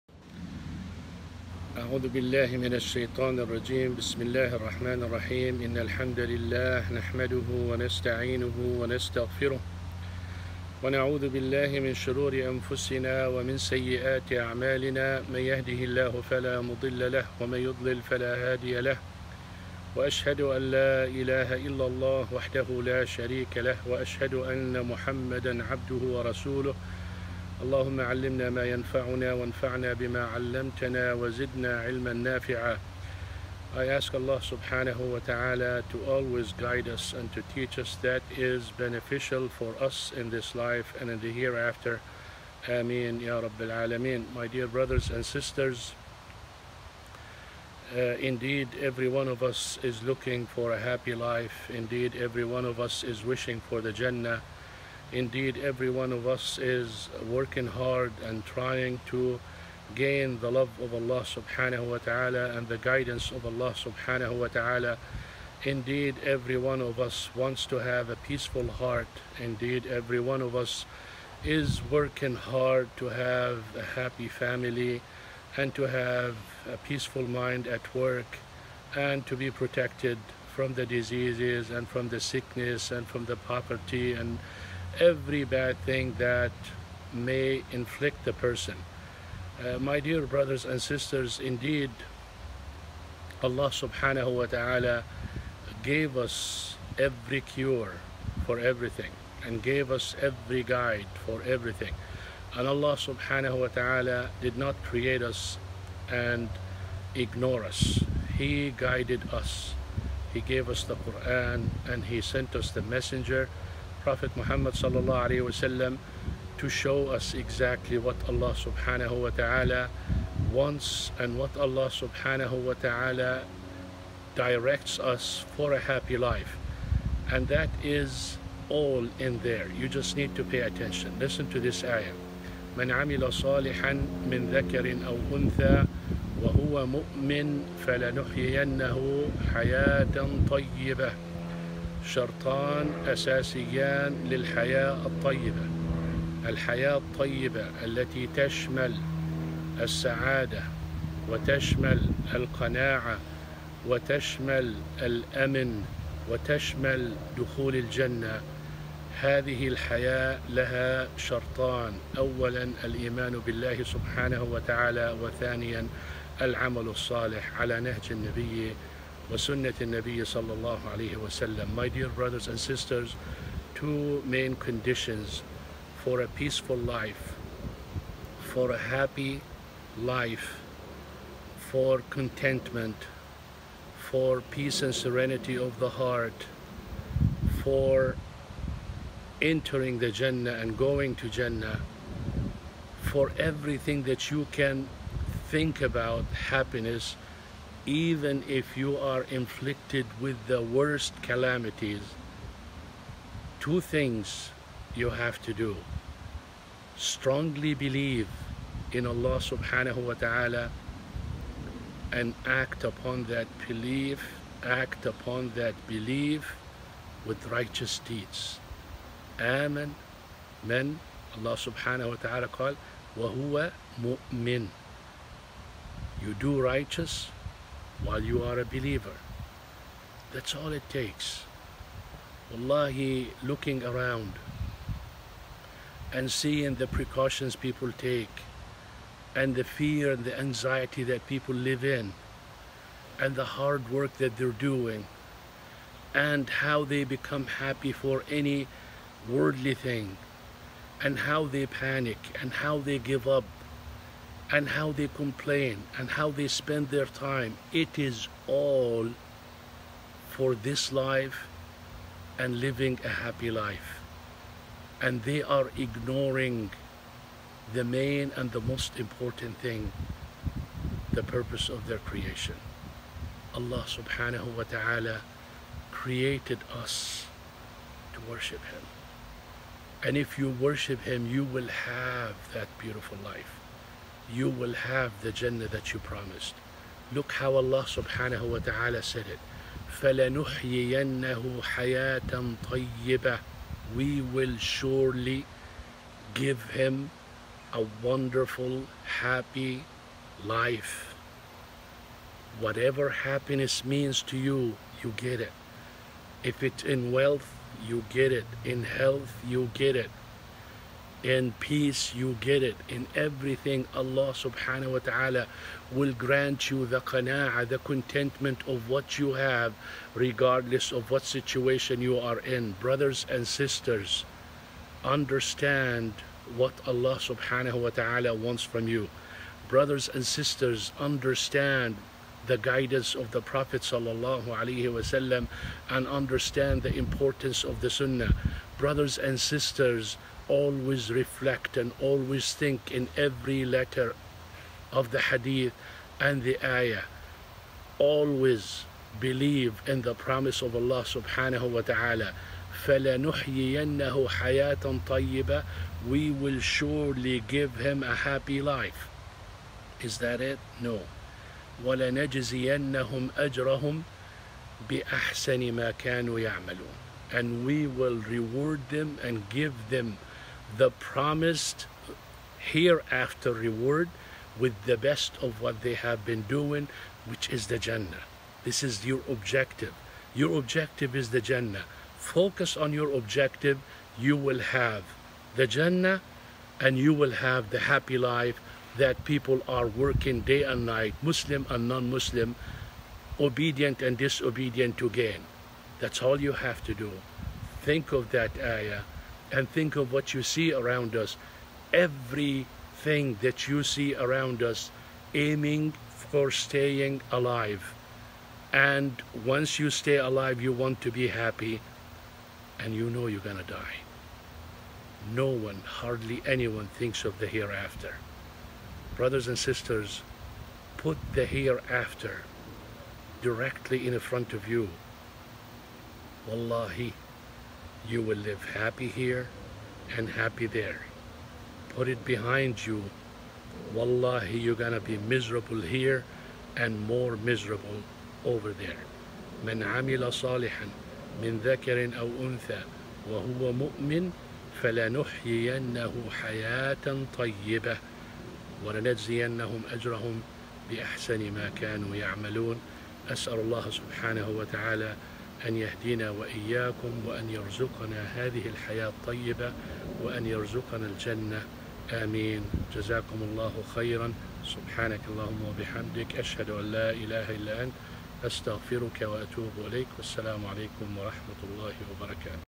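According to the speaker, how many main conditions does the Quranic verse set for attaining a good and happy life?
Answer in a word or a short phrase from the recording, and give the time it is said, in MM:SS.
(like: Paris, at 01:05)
2, at 02:53.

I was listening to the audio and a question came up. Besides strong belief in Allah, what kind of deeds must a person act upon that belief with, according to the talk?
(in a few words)
righteous deeds.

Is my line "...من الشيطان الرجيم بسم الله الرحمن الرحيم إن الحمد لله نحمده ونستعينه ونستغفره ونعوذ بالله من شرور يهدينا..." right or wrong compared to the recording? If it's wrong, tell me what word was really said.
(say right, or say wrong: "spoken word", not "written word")
wrong: "أنفسنا", not "يهدينا".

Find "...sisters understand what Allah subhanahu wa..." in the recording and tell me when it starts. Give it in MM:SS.
05:23.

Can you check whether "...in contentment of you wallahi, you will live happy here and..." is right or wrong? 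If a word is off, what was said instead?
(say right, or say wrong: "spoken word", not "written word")
wrong: "front", not "contentment".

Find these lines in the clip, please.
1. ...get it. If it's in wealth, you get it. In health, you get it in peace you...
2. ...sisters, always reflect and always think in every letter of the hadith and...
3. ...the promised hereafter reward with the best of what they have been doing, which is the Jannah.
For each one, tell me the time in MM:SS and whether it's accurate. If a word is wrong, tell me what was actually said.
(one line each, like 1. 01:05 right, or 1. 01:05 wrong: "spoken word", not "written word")
1. 05:05 right
2. 05:39 right
3. 06:10 right.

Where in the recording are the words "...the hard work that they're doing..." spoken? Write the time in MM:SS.
04:03.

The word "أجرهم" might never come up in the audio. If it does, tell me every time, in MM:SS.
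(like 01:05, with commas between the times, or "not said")
06:03, 07:29.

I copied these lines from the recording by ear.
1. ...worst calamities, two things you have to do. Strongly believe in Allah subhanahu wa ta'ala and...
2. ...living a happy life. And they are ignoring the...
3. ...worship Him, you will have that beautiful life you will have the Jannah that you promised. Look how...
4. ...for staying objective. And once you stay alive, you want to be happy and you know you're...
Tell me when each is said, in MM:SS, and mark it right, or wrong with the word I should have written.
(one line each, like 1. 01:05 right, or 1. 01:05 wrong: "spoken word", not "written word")
1. 03:20 right
2. 04:22 right
3. 04:40 right
4. 06:46 wrong: "alive", not "objective".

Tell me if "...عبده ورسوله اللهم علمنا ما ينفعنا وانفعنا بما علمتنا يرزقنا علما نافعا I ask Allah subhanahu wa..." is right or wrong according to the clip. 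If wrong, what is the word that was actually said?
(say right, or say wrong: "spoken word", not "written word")
wrong: "وزدنا", not "يرزقنا".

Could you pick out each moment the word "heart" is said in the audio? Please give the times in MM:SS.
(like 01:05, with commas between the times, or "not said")
01:08, 03:05.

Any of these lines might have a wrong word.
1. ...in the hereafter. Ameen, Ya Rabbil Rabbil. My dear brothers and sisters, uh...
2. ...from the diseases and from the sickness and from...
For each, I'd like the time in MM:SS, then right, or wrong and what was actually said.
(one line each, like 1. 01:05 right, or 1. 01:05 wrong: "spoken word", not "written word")
1. 00:41 wrong: "Alameen", not "Rabbil"
2. 01:20 right.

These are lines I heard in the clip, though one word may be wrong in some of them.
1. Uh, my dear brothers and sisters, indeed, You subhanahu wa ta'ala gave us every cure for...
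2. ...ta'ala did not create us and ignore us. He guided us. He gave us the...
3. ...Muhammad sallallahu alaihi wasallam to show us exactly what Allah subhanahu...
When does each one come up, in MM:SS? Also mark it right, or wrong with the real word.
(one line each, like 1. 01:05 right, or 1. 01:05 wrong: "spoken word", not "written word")
1. 01:29 wrong: "Allah", not "You"
2. 01:43 right
3. 01:54 right.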